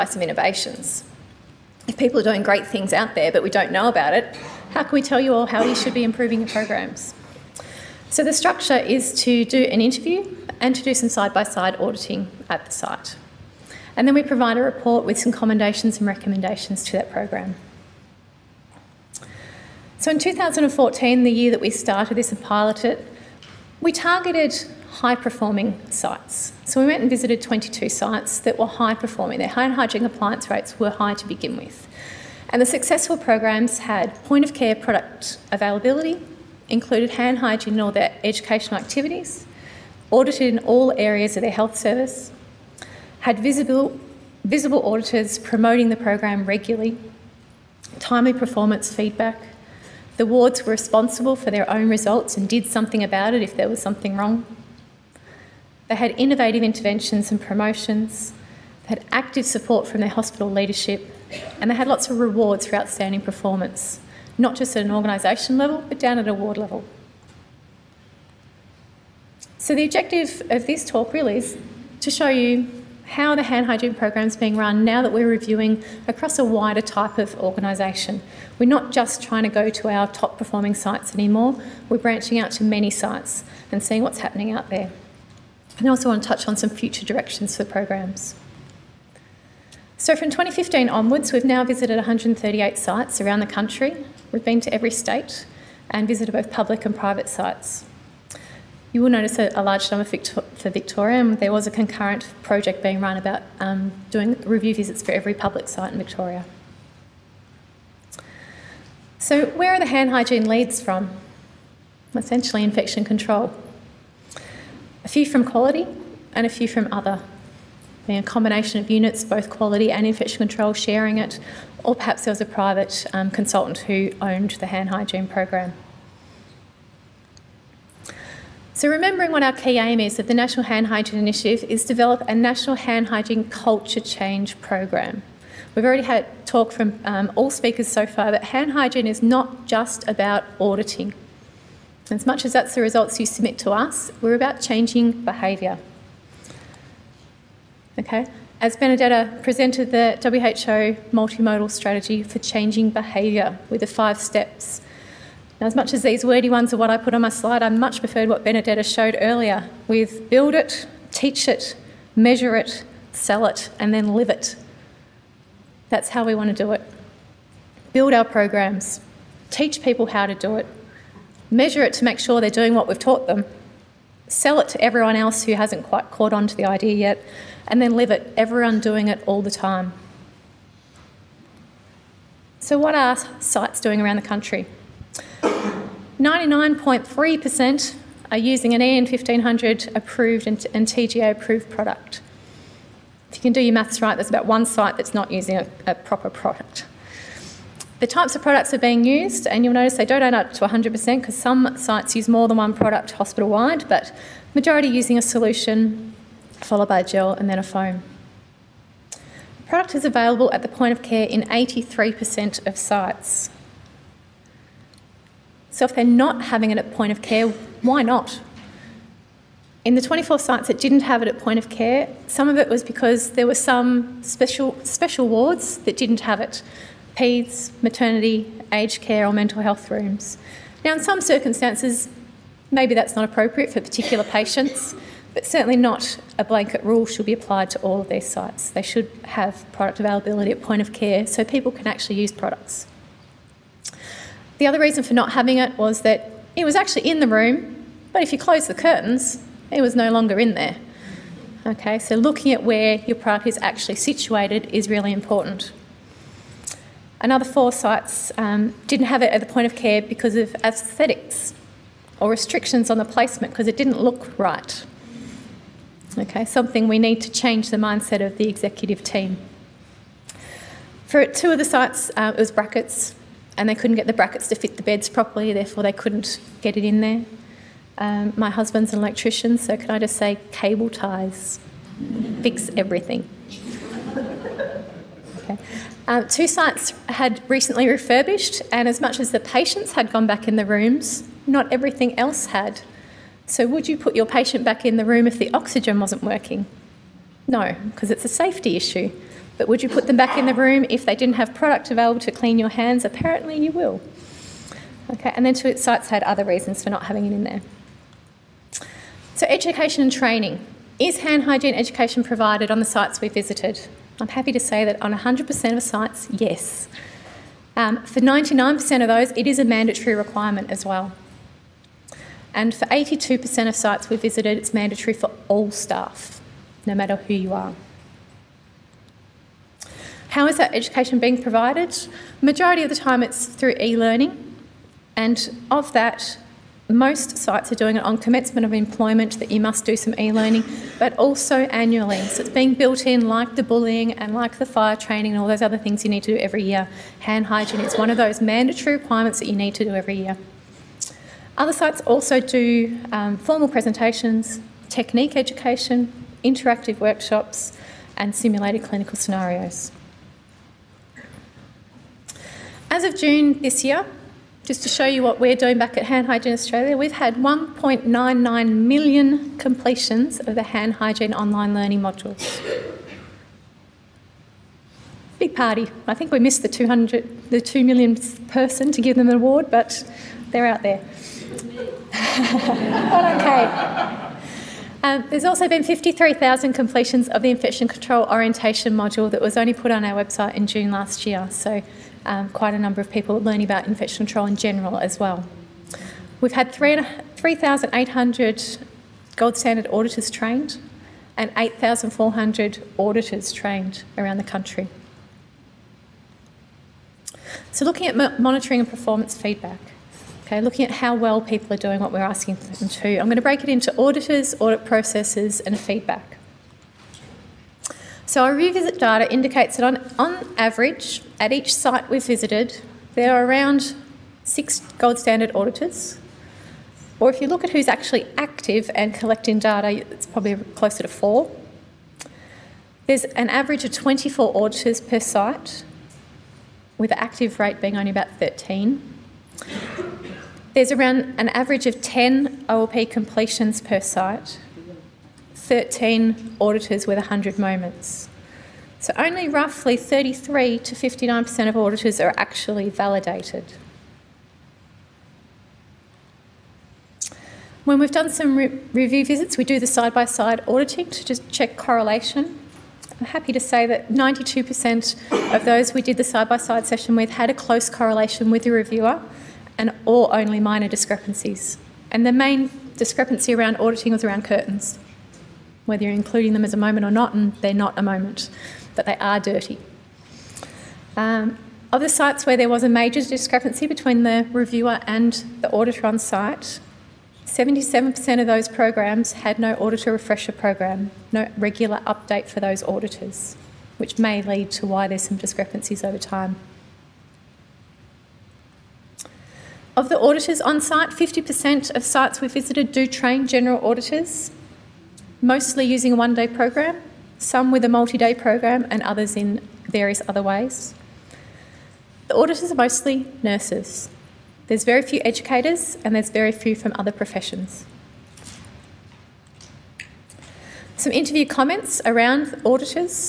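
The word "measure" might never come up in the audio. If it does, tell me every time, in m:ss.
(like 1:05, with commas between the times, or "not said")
2:42, 2:51.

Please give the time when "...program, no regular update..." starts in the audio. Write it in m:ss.
8:10.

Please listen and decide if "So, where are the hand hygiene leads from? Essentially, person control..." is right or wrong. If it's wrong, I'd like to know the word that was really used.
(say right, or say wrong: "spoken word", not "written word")
wrong: "infection", not "person".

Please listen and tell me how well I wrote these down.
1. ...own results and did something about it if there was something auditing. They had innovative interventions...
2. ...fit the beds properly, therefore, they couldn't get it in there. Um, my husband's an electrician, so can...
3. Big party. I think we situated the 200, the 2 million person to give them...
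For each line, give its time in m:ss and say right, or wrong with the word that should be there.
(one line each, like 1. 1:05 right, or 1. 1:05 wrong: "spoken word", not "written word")
1. 0:51 wrong: "wrong", not "auditing"
2. 4:34 right
3. 6:15 wrong: "missed", not "situated".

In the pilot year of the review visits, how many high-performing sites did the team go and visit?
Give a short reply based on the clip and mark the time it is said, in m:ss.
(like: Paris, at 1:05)
22, at 0:27.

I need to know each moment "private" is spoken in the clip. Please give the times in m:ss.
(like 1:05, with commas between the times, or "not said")
1:36, 2:02.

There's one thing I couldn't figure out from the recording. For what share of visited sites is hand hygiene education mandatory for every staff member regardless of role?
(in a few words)
82%.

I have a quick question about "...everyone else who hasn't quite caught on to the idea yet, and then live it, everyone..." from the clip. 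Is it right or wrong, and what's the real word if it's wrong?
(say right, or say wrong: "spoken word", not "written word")
right.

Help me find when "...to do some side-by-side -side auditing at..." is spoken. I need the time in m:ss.
0:10.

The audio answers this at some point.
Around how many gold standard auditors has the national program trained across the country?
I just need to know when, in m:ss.
6:36.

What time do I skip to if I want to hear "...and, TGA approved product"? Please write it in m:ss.
3:10.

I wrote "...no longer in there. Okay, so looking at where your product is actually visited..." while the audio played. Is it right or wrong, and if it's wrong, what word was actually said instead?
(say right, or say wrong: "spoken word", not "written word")
wrong: "situated", not "visited".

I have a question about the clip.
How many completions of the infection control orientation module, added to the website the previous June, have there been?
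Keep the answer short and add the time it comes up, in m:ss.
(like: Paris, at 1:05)
53,000, at 6:25.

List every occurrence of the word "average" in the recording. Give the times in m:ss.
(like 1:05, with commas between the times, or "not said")
7:00, 7:13, 7:21.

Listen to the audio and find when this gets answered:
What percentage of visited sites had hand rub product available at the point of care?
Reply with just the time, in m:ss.
3:31.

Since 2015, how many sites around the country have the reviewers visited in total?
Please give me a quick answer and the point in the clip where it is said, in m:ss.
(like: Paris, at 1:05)
138, at 1:31.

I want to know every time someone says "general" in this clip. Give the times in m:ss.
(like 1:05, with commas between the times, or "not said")
6:34, 8:23.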